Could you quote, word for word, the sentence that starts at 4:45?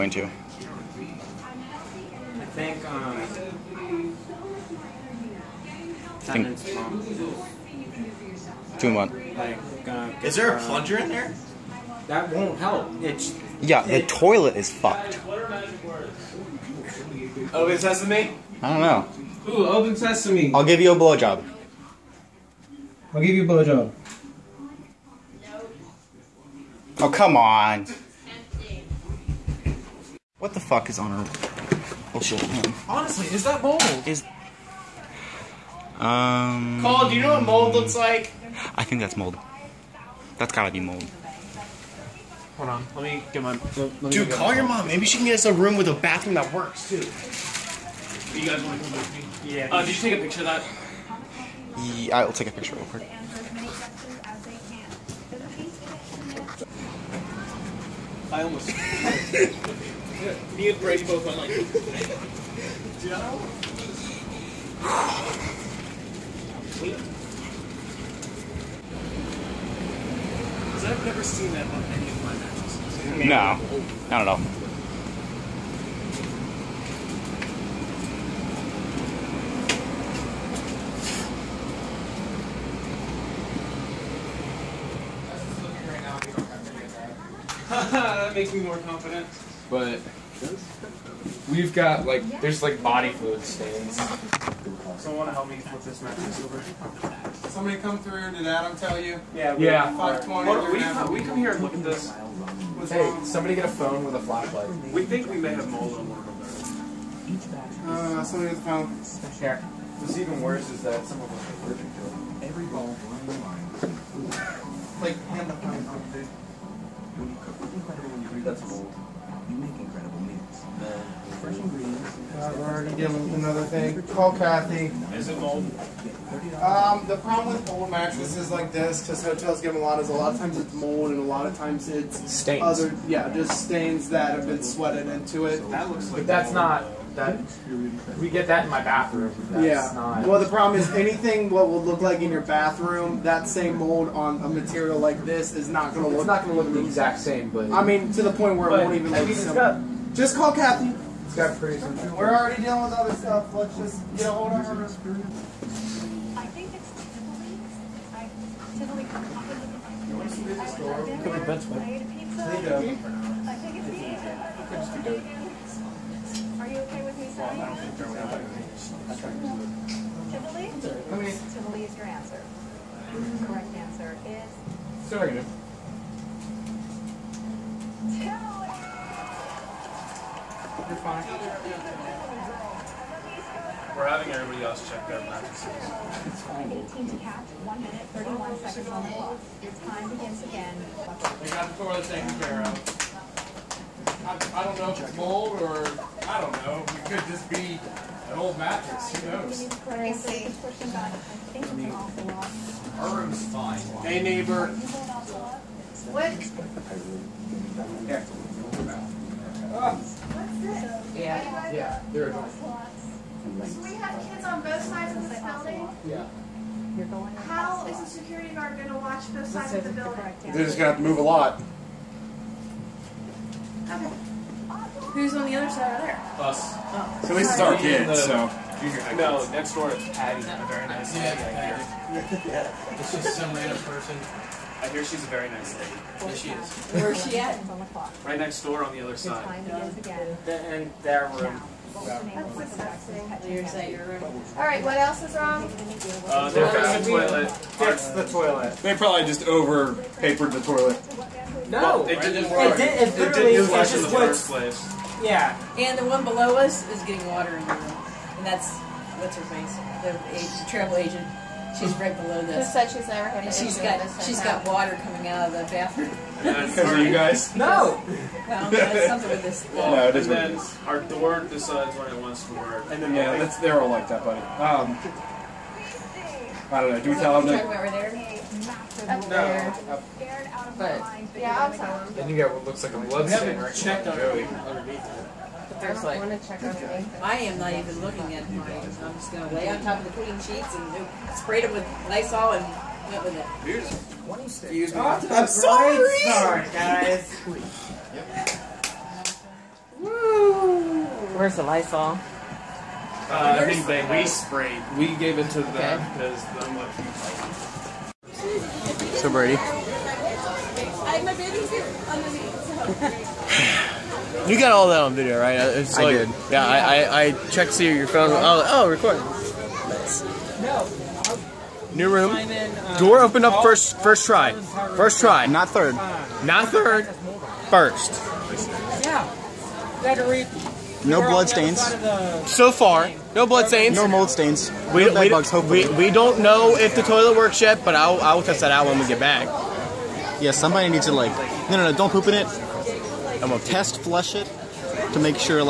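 But there's I don't like, want to check on I am not even looking at mine.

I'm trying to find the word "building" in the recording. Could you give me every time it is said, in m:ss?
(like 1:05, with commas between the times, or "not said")
3:35, 3:39.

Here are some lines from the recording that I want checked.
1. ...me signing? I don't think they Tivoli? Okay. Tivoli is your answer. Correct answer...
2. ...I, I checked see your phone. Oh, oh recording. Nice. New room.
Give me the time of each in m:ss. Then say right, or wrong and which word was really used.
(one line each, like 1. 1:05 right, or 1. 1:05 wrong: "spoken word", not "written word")
1. 2:47 right
2. 5:17 right.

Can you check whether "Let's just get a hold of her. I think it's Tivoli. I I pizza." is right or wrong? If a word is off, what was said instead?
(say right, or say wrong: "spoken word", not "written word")
right.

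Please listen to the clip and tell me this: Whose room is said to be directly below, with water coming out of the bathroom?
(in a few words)
the travel agent.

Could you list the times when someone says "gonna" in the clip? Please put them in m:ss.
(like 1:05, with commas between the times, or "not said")
3:38, 5:43.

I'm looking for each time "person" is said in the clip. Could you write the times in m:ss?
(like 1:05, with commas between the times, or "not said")
3:53.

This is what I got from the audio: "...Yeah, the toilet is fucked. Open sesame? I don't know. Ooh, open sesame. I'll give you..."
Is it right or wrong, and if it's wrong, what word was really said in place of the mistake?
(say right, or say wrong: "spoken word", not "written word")
right.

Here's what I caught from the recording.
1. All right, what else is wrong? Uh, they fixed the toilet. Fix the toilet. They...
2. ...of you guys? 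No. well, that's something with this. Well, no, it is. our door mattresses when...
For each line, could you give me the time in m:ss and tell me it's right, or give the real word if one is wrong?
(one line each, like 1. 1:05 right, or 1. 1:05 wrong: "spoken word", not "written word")
1. 4:04 right
2. 4:26 wrong: "decides", not "mattresses".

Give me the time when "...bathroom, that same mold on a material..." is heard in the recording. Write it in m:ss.
2:22.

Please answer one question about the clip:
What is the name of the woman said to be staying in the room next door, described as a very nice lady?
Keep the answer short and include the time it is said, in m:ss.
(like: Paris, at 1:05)
Patty, at 3:50.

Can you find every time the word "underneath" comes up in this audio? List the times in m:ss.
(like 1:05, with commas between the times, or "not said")
4:44.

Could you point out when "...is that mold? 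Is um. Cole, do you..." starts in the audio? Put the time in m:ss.
0:33.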